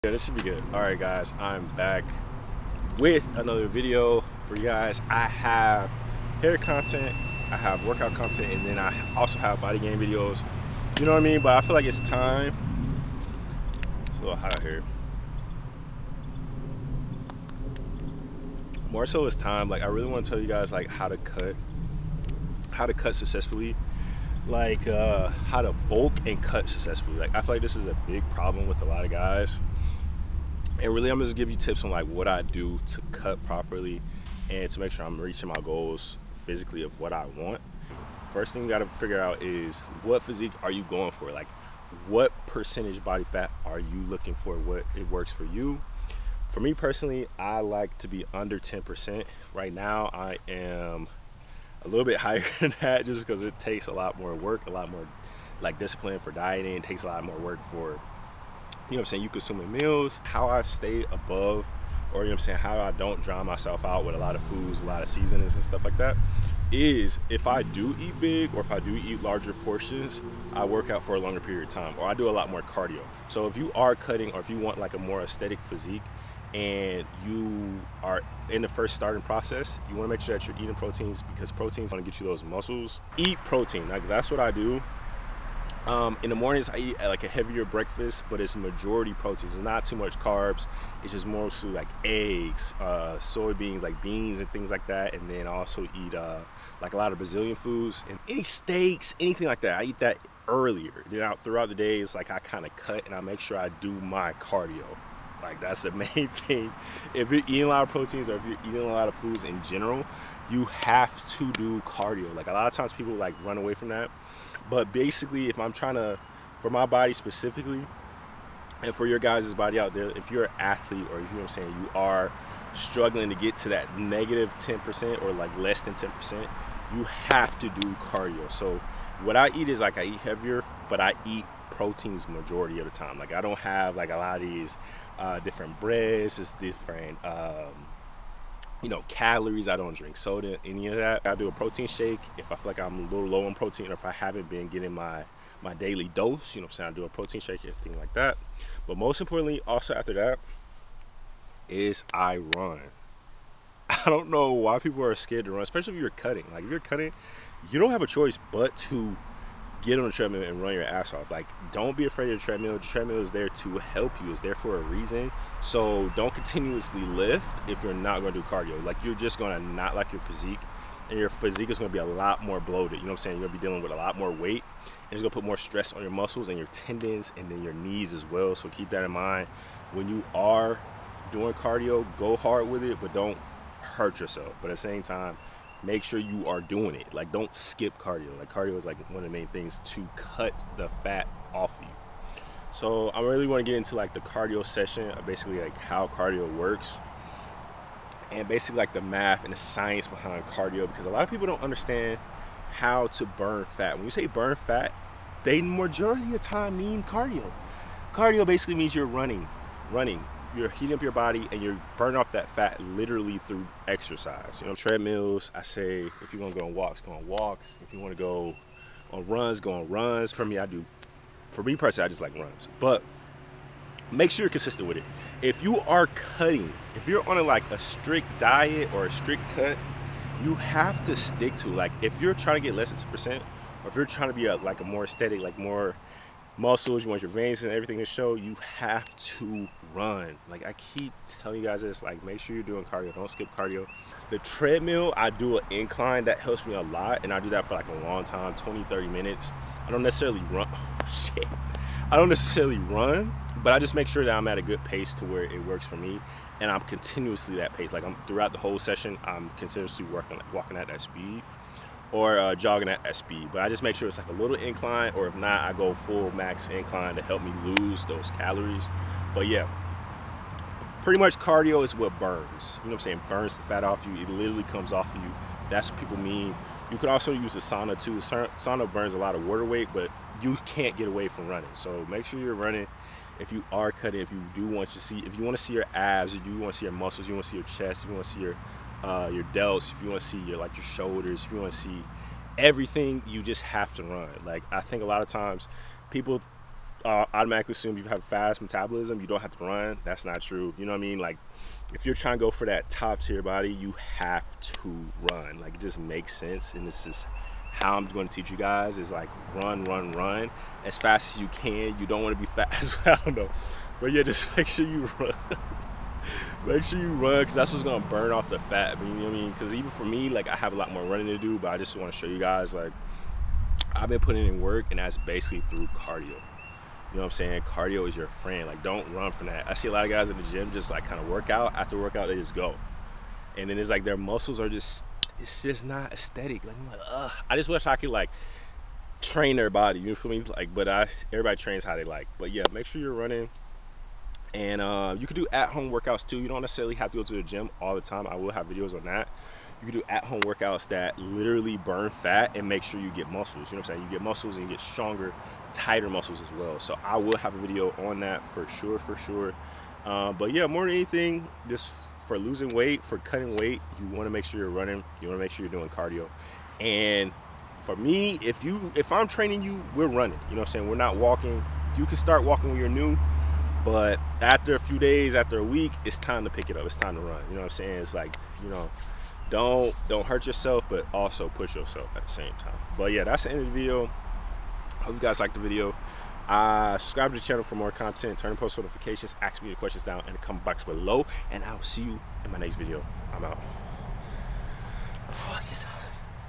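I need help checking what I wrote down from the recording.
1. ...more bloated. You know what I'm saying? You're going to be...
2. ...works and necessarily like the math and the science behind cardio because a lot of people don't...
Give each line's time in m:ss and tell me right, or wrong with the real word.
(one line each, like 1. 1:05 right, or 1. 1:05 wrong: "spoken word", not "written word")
1. 2:52 right
2. 3:16 wrong: "basically", not "necessarily".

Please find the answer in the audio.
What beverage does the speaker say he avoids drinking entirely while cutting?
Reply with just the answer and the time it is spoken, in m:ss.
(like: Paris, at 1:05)
soda, at 2:20.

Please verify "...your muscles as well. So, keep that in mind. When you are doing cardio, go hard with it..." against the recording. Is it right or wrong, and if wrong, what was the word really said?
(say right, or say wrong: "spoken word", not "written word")
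wrong: "knees", not "muscles".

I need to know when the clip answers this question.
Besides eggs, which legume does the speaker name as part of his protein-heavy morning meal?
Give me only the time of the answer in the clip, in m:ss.
1:33.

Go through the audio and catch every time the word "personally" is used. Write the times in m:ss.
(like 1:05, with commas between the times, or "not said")
0:46, 3:41.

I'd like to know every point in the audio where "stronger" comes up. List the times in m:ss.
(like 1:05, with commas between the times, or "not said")
5:54.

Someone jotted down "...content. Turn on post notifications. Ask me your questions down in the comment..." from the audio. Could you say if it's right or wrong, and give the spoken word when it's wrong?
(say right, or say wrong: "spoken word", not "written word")
right.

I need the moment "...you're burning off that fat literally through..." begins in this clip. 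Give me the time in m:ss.
3:31.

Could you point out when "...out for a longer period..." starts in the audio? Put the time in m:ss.
1:10.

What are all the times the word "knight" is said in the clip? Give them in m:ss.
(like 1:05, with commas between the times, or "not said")
not said.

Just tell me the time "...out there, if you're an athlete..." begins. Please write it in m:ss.
1:59.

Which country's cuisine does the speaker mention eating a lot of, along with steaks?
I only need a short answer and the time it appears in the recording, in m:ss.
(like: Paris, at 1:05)
Brazilian, at 1:37.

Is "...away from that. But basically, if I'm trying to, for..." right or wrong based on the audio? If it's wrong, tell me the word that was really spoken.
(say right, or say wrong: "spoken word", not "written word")
right.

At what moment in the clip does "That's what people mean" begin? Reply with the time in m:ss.
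4:35.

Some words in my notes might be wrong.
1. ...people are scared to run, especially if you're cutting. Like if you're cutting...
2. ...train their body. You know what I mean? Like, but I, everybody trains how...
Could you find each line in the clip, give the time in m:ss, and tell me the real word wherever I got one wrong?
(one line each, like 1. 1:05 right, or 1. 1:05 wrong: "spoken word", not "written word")
1. 2:34 right
2. 5:39 right.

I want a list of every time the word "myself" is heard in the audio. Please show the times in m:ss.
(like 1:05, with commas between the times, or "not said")
1:03.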